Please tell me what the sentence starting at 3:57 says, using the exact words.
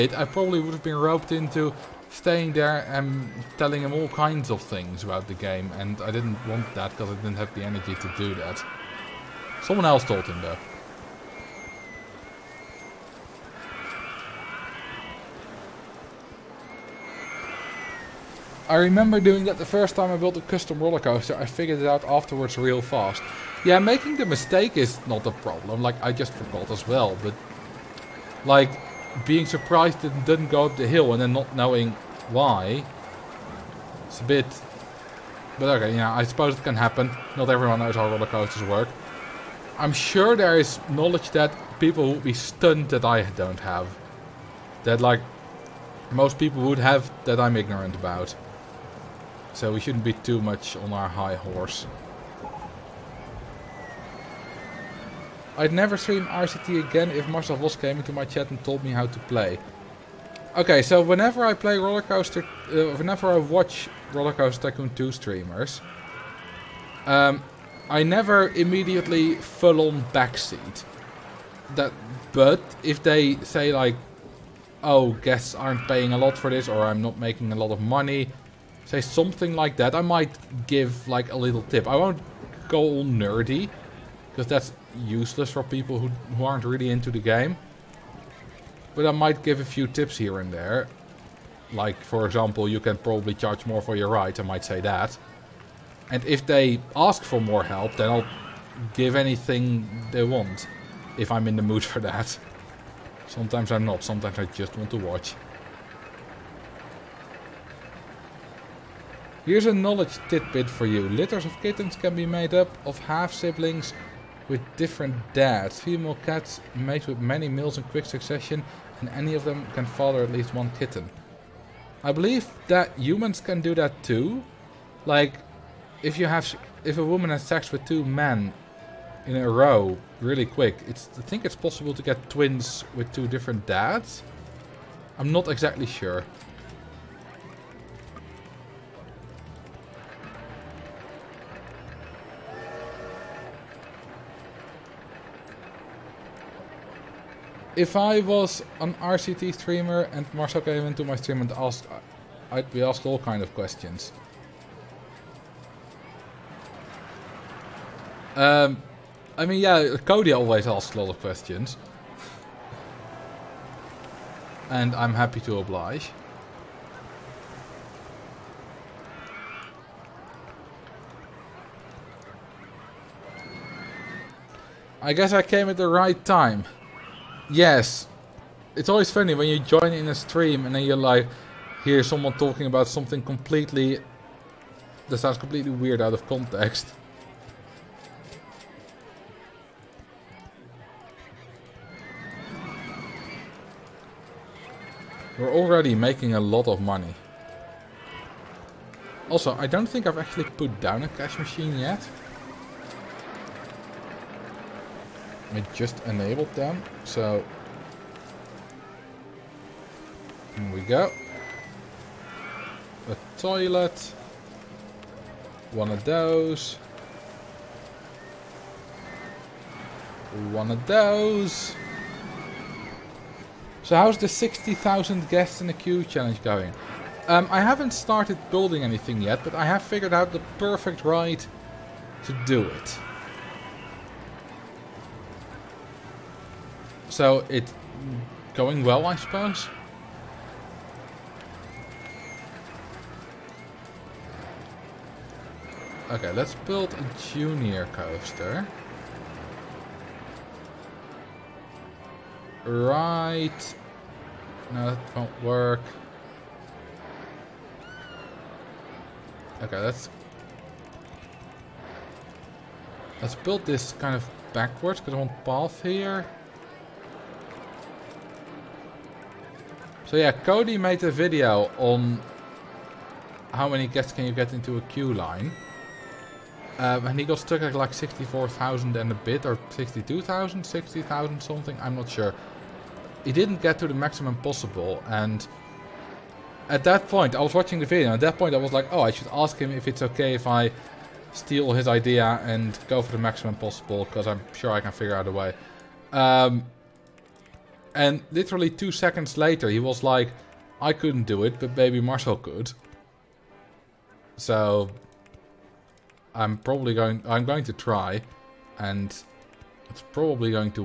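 So it's going well, I suppose.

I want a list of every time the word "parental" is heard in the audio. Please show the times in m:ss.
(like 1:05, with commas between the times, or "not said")
not said.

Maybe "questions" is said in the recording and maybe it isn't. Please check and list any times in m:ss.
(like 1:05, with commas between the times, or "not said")
2:33, 2:41.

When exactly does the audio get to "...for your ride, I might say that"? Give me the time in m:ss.
1:33.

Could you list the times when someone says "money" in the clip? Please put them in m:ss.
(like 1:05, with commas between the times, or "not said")
1:17, 3:16.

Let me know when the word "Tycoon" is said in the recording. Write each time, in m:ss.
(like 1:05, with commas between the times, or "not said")
1:04.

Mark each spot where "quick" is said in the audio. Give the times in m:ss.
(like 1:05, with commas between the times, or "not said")
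1:57, 2:10.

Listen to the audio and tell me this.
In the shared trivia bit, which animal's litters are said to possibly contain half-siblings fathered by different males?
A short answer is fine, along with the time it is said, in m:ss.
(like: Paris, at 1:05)
Kittens, at 1:51.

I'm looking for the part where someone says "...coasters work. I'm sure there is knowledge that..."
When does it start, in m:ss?
0:38.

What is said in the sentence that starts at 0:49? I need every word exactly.
So we shouldn't be too much on our high horse.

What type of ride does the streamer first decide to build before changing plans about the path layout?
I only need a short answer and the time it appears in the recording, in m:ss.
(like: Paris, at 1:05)
Junior coaster, at 4:07.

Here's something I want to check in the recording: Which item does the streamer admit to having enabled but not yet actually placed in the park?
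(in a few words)
Cash machine.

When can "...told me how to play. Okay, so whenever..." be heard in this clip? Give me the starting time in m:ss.
0:58.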